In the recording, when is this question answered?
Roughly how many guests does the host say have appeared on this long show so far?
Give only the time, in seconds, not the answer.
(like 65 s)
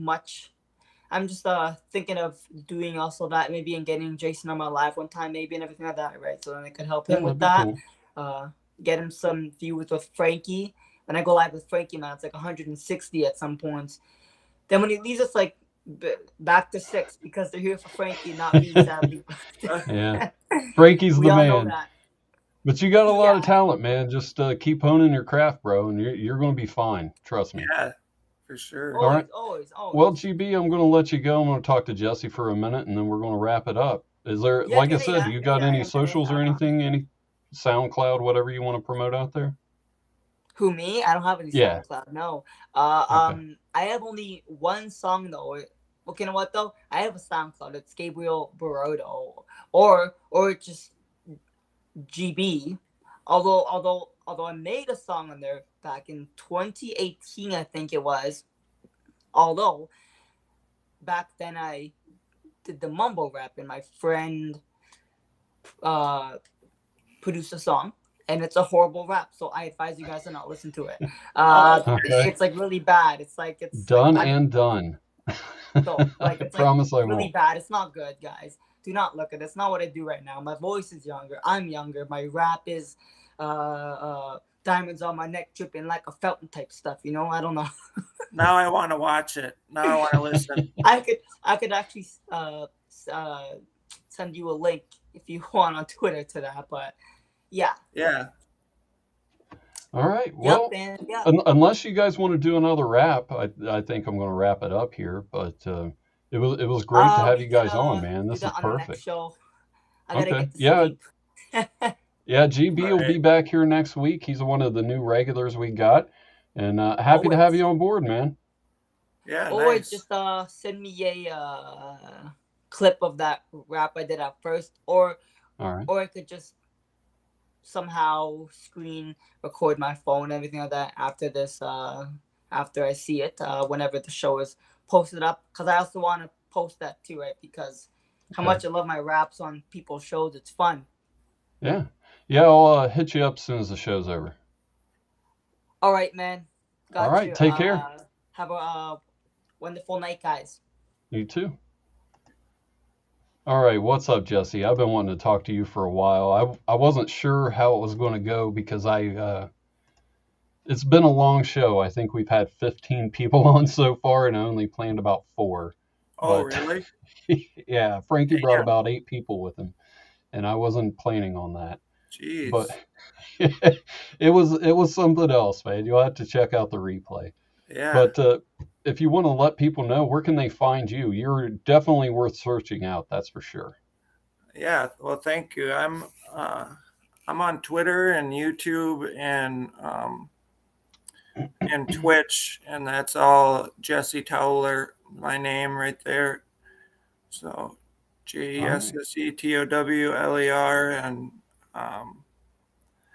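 162 s.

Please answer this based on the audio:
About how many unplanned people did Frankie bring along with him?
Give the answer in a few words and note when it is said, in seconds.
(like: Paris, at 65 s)
8, at 168 s.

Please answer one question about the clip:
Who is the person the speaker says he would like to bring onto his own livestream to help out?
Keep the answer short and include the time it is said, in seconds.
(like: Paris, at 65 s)
Jason, at 4 s.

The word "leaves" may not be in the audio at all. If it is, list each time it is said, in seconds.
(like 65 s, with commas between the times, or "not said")
14 s.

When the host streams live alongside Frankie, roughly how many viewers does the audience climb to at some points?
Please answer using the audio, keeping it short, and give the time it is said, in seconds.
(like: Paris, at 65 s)
160, at 12 s.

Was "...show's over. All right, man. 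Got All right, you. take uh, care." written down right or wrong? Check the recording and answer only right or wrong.
right.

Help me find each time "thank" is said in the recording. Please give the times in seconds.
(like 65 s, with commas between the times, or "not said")
185 s.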